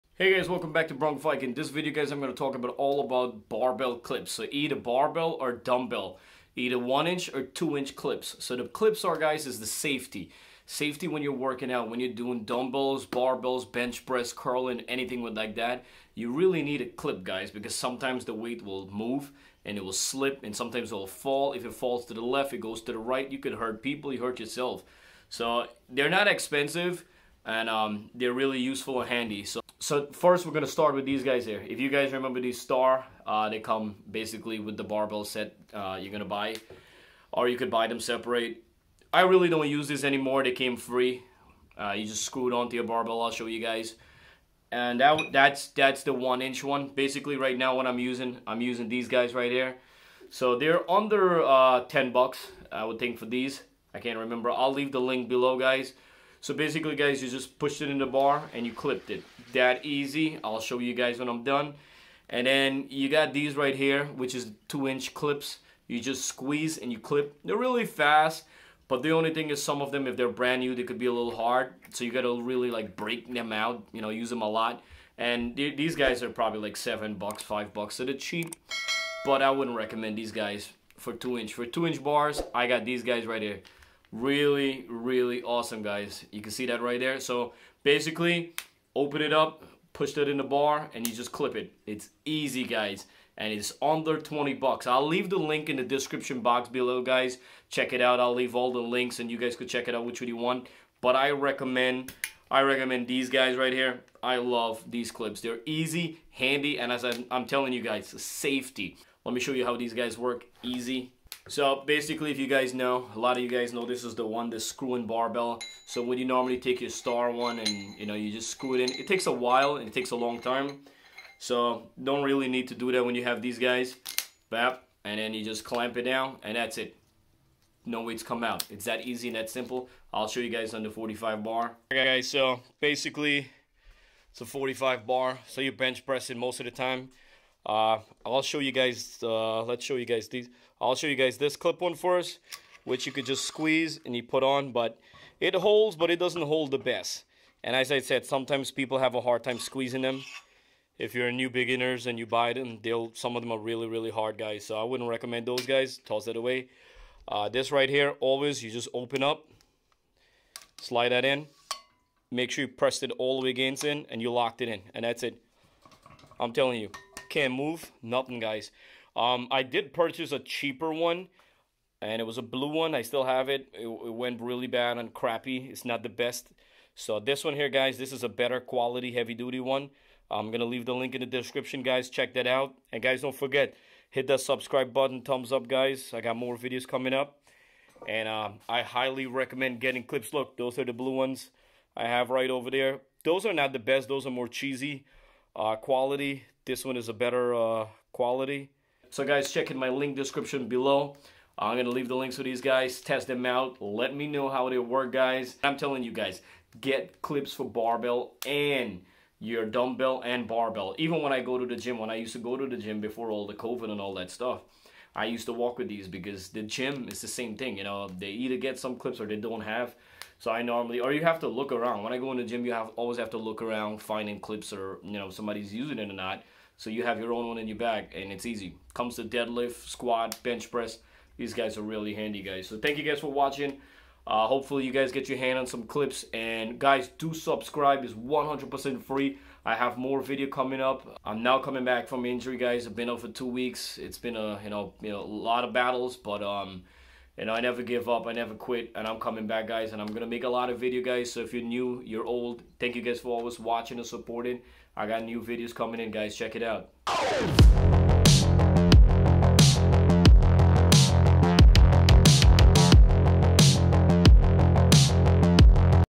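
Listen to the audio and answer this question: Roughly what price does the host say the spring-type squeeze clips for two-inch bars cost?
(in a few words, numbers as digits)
7 bucks.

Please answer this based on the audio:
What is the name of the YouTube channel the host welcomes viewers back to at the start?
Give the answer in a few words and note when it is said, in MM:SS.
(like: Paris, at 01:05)
Brownviking, at 00:00.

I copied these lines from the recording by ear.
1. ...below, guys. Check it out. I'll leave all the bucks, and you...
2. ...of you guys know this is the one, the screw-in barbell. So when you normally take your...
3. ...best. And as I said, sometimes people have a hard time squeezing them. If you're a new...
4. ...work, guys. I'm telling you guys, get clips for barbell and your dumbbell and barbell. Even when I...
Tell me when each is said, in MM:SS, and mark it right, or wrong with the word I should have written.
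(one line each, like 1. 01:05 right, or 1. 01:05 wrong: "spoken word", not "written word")
1. 01:36 wrong: "links", not "bucks"
2. 01:53 right
3. 02:26 right
4. 03:24 right.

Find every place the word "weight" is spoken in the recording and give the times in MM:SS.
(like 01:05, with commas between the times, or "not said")
00:18, 02:08.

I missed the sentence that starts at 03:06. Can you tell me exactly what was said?
I got more videos coming up.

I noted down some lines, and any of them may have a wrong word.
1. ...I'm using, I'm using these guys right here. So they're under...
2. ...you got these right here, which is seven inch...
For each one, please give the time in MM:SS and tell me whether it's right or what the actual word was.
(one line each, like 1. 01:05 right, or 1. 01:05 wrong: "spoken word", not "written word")
1. 00:47 right
2. 01:02 wrong: "two", not "seven".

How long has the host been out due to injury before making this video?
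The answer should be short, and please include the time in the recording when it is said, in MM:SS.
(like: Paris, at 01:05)
2 weeks, at 04:03.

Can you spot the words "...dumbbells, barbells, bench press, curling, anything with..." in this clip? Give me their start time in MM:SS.
00:12.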